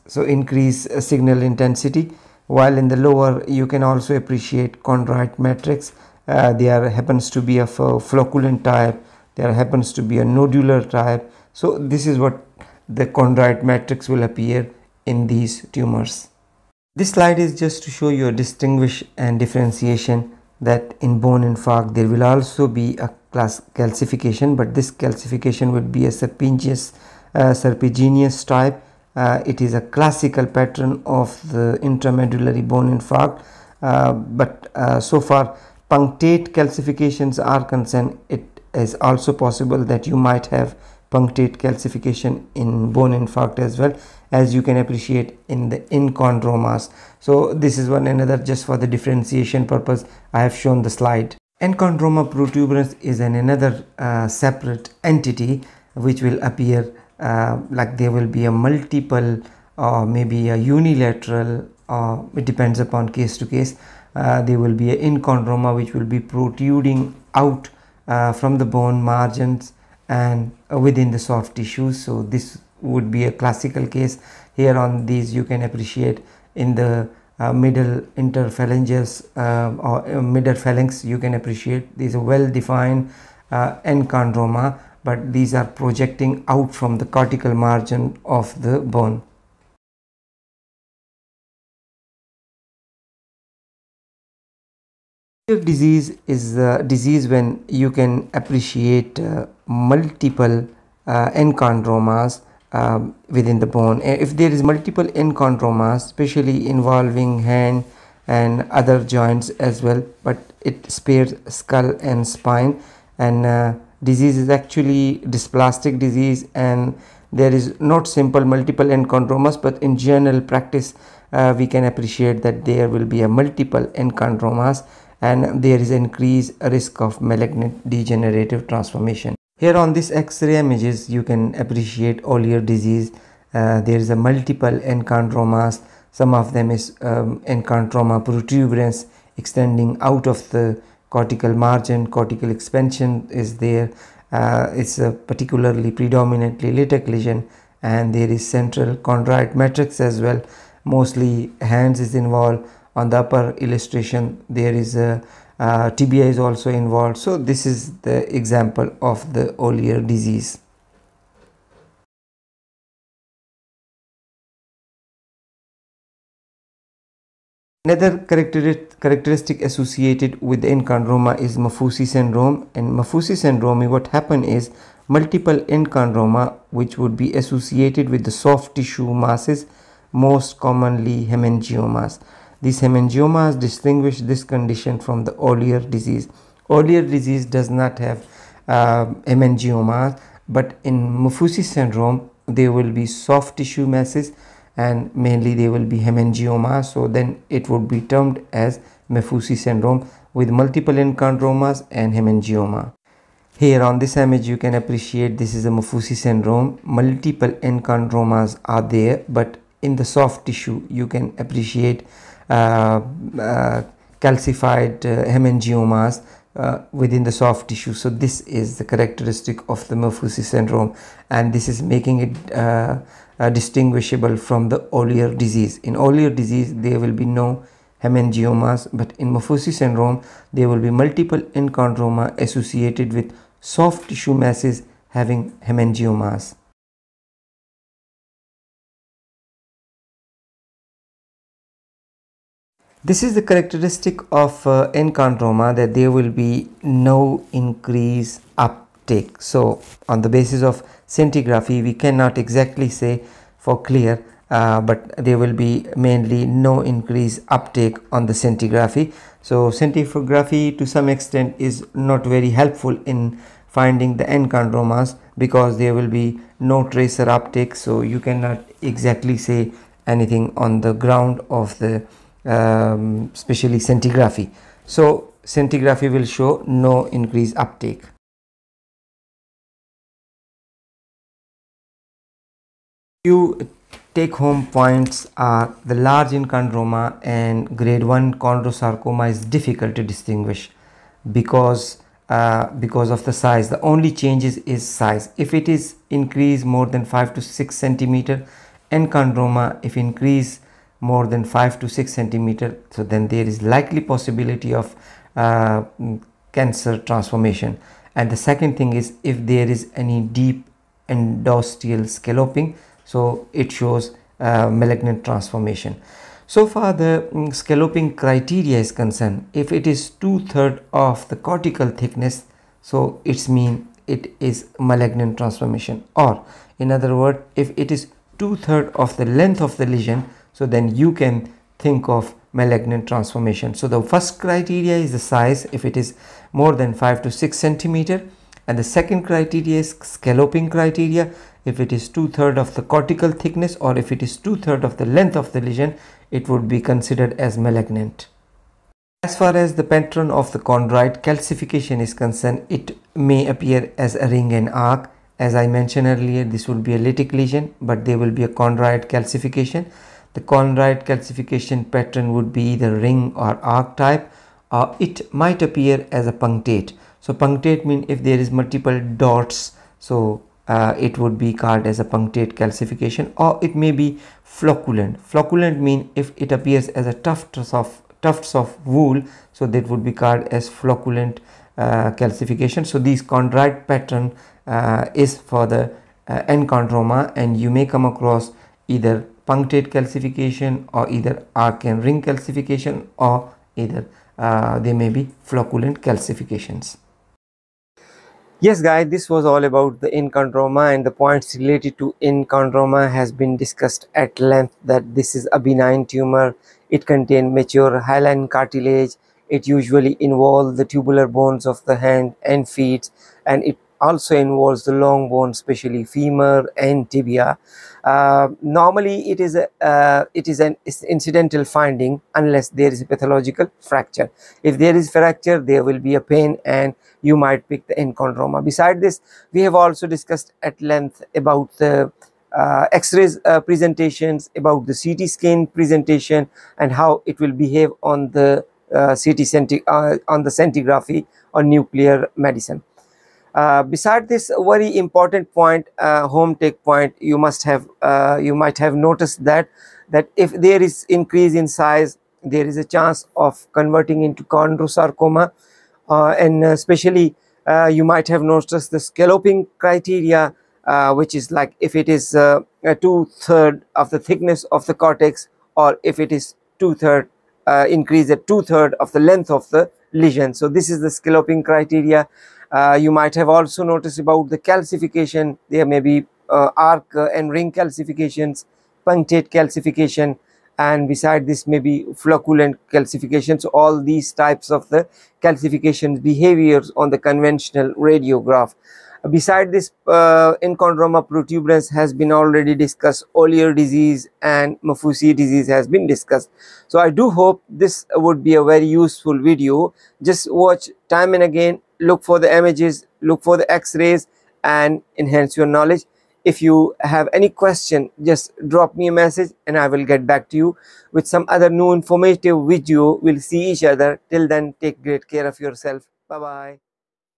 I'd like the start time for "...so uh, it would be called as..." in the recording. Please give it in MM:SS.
06:09.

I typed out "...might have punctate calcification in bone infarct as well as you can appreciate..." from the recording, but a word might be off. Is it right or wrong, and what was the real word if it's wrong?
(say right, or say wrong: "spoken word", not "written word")
right.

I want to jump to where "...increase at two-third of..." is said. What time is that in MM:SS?
07:47.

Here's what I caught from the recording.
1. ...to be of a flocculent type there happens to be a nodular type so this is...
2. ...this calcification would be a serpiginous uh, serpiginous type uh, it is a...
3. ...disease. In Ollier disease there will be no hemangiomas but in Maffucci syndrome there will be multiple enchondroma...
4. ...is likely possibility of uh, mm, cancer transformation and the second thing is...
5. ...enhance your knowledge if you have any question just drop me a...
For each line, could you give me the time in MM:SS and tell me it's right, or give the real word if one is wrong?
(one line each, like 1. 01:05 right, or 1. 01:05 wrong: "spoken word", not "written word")
1. 00:07 right
2. 00:24 right
3. 03:45 right
4. 05:03 right
5. 08:25 right.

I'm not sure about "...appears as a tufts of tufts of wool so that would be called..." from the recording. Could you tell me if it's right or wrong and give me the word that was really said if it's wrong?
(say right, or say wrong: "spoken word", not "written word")
right.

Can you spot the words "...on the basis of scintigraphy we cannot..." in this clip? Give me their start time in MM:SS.
04:10.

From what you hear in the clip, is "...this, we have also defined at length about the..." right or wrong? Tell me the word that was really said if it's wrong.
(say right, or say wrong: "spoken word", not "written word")
wrong: "discussed", not "defined".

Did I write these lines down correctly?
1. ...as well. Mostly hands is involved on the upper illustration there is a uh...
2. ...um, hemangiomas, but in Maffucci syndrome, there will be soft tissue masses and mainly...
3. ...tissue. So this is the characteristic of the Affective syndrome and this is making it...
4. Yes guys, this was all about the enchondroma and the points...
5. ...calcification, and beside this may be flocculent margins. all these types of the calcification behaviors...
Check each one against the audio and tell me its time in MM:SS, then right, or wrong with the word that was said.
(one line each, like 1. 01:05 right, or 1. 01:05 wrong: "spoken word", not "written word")
1. 02:29 right
2. 03:09 right
3. 03:37 wrong: "Maffucci", not "Affective"
4. 06:38 right
5. 07:59 wrong: "calcifications", not "margins".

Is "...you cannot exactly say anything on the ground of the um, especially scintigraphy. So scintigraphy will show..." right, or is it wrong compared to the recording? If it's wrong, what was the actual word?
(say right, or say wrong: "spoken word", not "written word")
right.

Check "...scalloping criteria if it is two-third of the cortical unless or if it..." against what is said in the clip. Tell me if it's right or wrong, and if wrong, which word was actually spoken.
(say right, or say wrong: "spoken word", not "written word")
wrong: "thickness", not "unless".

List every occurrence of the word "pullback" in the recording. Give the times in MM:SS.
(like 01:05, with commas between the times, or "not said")
not said.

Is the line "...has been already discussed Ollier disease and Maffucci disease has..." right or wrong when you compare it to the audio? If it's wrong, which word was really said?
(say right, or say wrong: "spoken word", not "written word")
right.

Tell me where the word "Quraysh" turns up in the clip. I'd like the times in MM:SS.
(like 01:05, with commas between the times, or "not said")
not said.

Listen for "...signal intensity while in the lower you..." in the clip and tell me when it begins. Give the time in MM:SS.
00:01.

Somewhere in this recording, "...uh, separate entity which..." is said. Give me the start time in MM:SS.
00:53.